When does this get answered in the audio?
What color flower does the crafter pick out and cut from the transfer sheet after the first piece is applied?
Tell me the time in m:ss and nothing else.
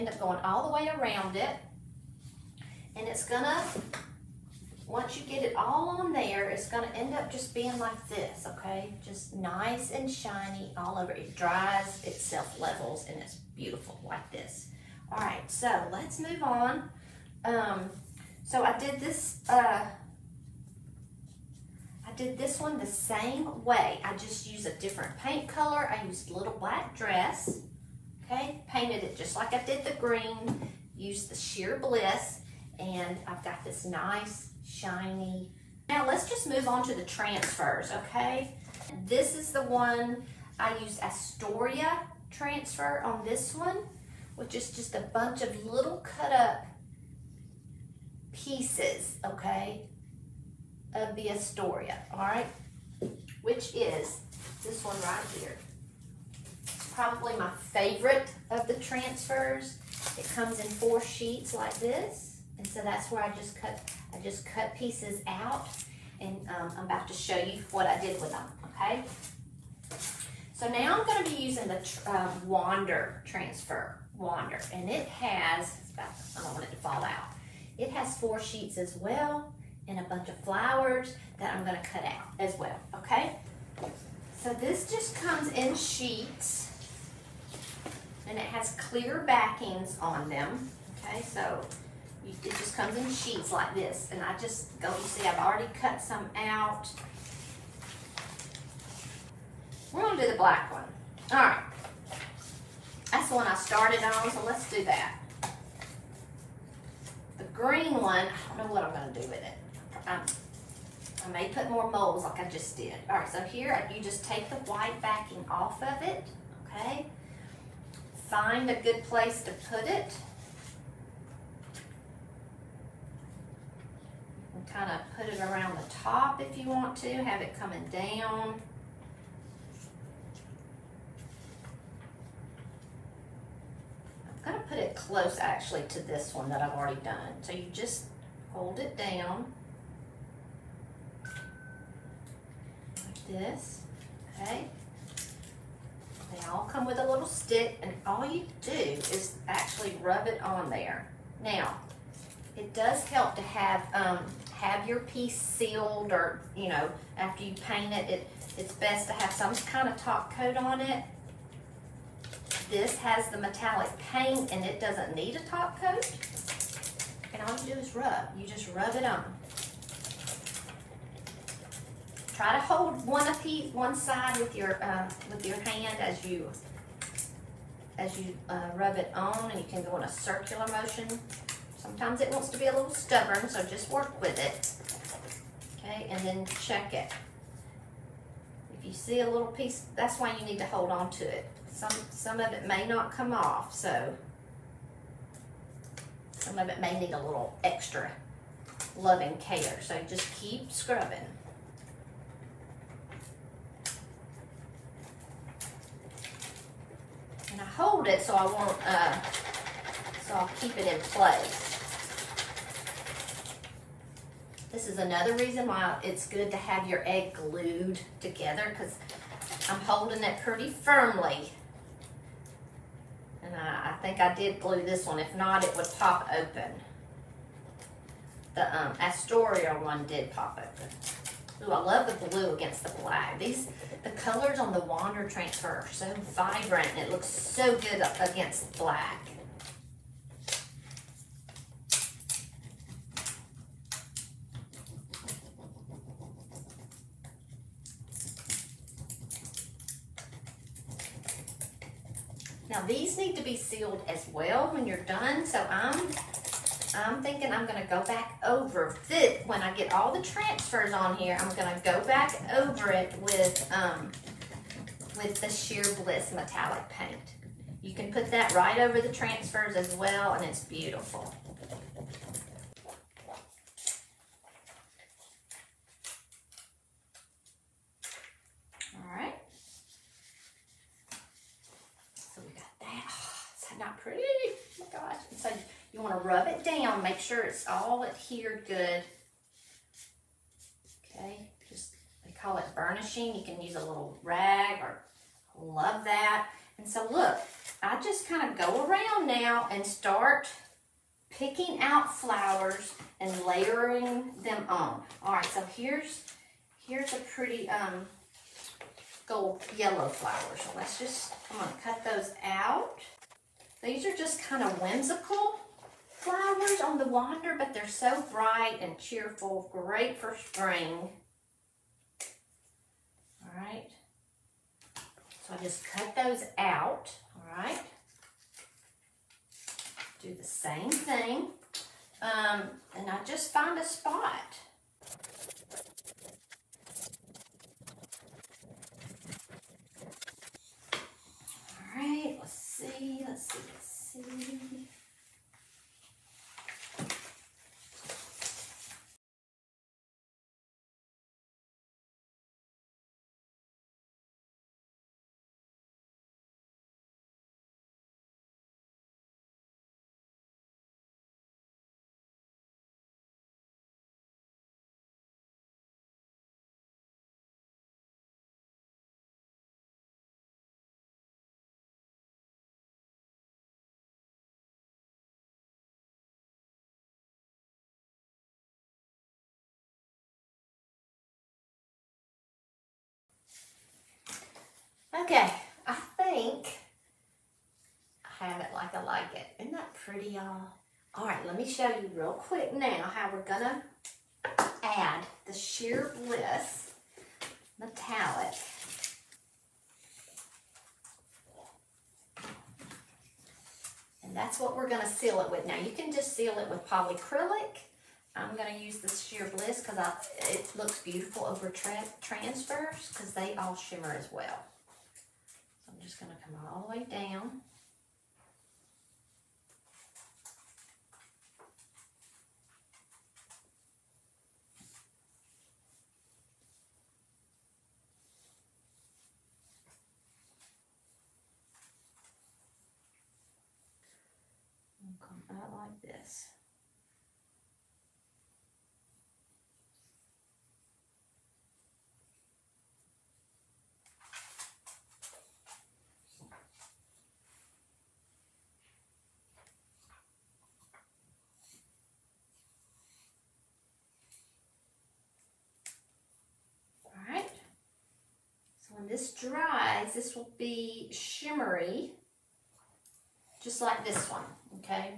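5:09.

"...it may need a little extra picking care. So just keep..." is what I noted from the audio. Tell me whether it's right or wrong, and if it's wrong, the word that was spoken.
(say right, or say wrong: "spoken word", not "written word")
wrong: "loving", not "picking".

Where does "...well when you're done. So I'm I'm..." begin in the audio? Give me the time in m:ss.
4:14.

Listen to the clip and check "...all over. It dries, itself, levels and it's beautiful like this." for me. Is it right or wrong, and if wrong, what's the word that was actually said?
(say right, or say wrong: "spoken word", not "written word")
right.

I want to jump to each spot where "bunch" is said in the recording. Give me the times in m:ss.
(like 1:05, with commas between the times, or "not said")
0:45, 1:20.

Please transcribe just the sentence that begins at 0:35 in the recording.
Now let's just move on to the transfers, okay?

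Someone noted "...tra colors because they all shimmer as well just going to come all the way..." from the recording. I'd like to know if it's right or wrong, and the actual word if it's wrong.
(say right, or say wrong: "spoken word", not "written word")
wrong: "transfers", not "colors".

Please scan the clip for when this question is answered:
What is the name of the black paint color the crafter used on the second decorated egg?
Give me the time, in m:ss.
0:26.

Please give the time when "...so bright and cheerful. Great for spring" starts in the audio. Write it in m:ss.
5:17.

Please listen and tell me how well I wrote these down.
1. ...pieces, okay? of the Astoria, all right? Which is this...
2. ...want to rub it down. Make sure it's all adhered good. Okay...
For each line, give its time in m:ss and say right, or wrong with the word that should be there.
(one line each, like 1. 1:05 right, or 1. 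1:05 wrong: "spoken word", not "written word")
1. 0:48 right
2. 4:45 right.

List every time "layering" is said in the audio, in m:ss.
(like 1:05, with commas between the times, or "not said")
5:03.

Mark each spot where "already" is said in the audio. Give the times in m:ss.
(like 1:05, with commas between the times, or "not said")
1:35, 2:16.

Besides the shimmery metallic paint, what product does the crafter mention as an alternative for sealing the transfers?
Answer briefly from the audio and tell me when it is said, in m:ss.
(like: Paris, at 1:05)
Polyacrylic, at 6:46.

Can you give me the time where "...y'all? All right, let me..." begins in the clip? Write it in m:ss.
6:30.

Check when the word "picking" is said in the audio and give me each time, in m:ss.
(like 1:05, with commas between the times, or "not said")
5:01.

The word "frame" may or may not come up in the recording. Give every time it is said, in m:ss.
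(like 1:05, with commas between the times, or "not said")
not said.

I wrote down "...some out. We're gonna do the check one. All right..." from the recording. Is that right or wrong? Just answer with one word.
wrong.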